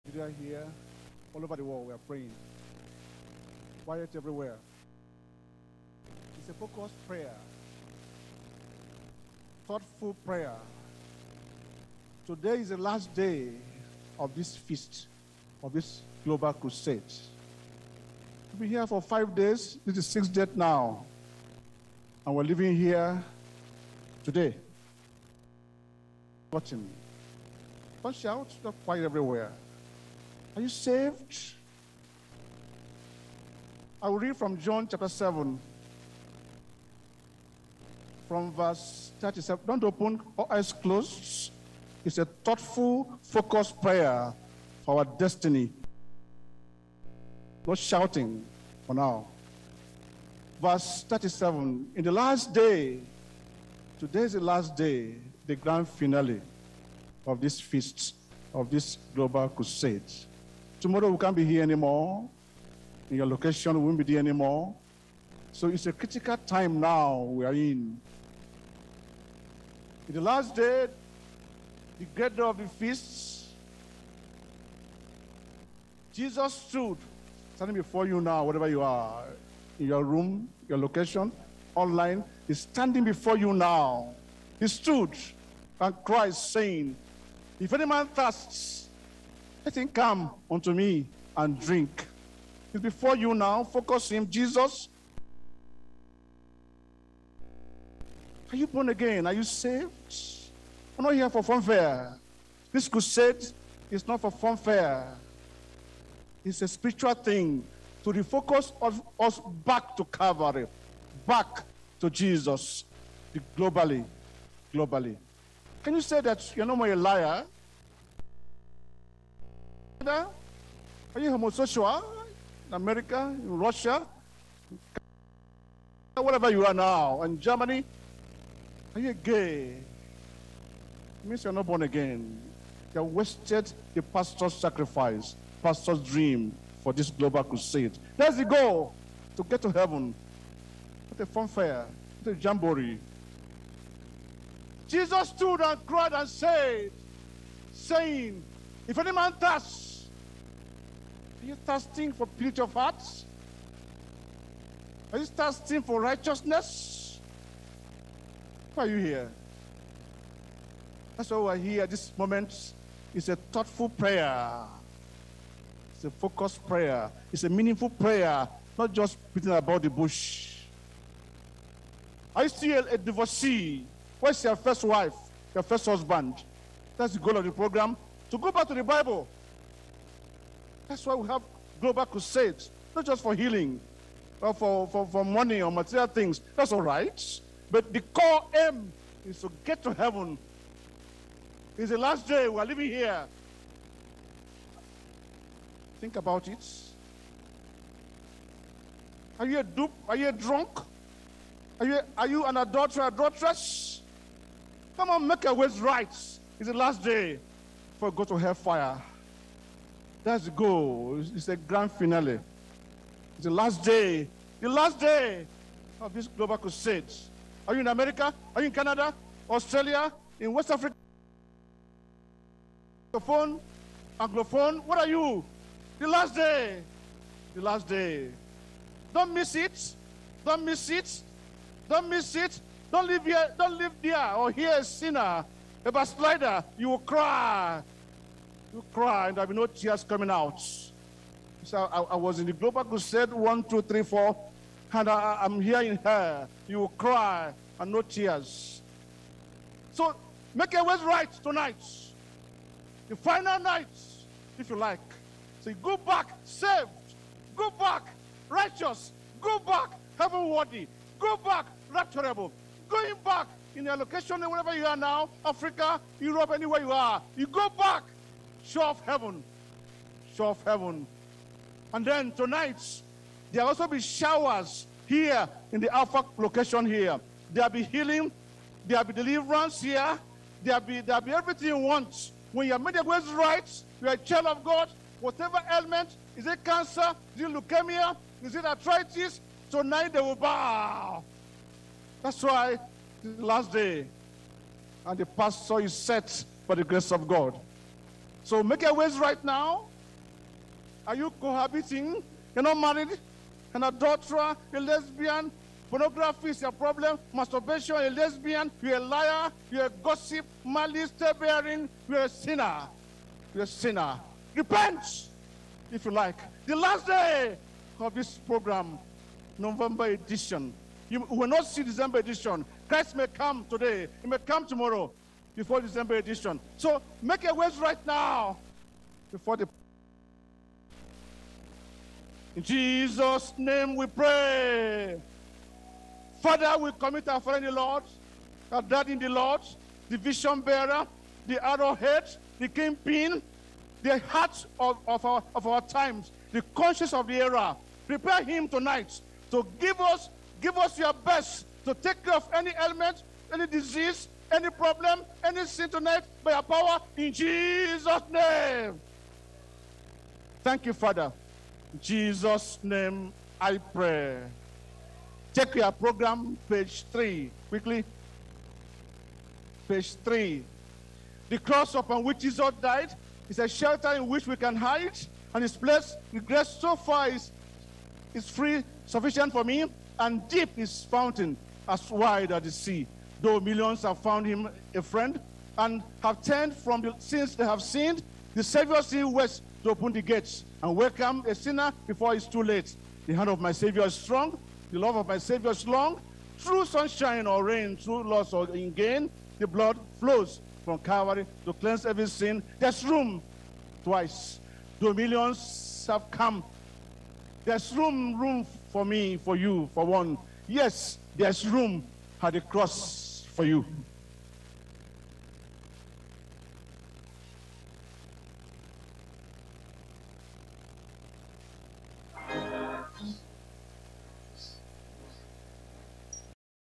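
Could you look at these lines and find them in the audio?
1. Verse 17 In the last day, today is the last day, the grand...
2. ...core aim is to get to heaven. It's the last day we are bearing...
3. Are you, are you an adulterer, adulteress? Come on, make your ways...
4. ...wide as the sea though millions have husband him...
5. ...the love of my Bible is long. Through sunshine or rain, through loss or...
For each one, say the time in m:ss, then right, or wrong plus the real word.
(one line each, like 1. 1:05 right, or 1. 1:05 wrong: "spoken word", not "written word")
1. 0:50 wrong: "37", not "17"
2. 3:08 wrong: "living", not "bearing"
3. 3:21 right
4. 6:22 wrong: "found", not "husband"
5. 6:34 wrong: "Savior", not "Bible".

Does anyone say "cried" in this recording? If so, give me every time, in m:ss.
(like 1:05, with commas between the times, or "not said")
2:25.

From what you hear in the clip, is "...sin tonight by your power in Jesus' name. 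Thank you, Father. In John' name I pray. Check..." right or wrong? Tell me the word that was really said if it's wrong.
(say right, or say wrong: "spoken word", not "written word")
wrong: "Jesus", not "John".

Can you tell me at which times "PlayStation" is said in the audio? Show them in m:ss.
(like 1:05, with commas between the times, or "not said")
not said.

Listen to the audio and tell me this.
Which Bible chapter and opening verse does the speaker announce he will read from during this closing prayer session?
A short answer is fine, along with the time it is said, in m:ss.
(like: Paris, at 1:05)
John 7:37, at 0:34.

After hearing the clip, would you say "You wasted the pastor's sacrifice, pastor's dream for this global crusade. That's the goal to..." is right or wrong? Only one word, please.
right.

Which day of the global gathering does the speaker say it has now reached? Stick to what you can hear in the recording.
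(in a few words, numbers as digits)
Sixth day.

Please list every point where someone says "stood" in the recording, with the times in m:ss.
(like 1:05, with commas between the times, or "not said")
1:16, 1:24, 2:25.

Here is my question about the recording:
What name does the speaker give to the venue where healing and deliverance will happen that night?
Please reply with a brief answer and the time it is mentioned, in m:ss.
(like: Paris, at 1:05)
Alpha location, at 4:35.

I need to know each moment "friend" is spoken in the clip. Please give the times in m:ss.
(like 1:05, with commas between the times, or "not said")
5:37, 6:25.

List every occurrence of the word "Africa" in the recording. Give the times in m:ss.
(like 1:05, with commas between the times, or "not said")
3:40, 4:25.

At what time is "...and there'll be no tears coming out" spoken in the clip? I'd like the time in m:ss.
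3:59.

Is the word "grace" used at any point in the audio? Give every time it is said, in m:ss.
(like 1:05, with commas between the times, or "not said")
4:56, 6:16.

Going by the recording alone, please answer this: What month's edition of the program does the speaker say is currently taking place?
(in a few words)
November.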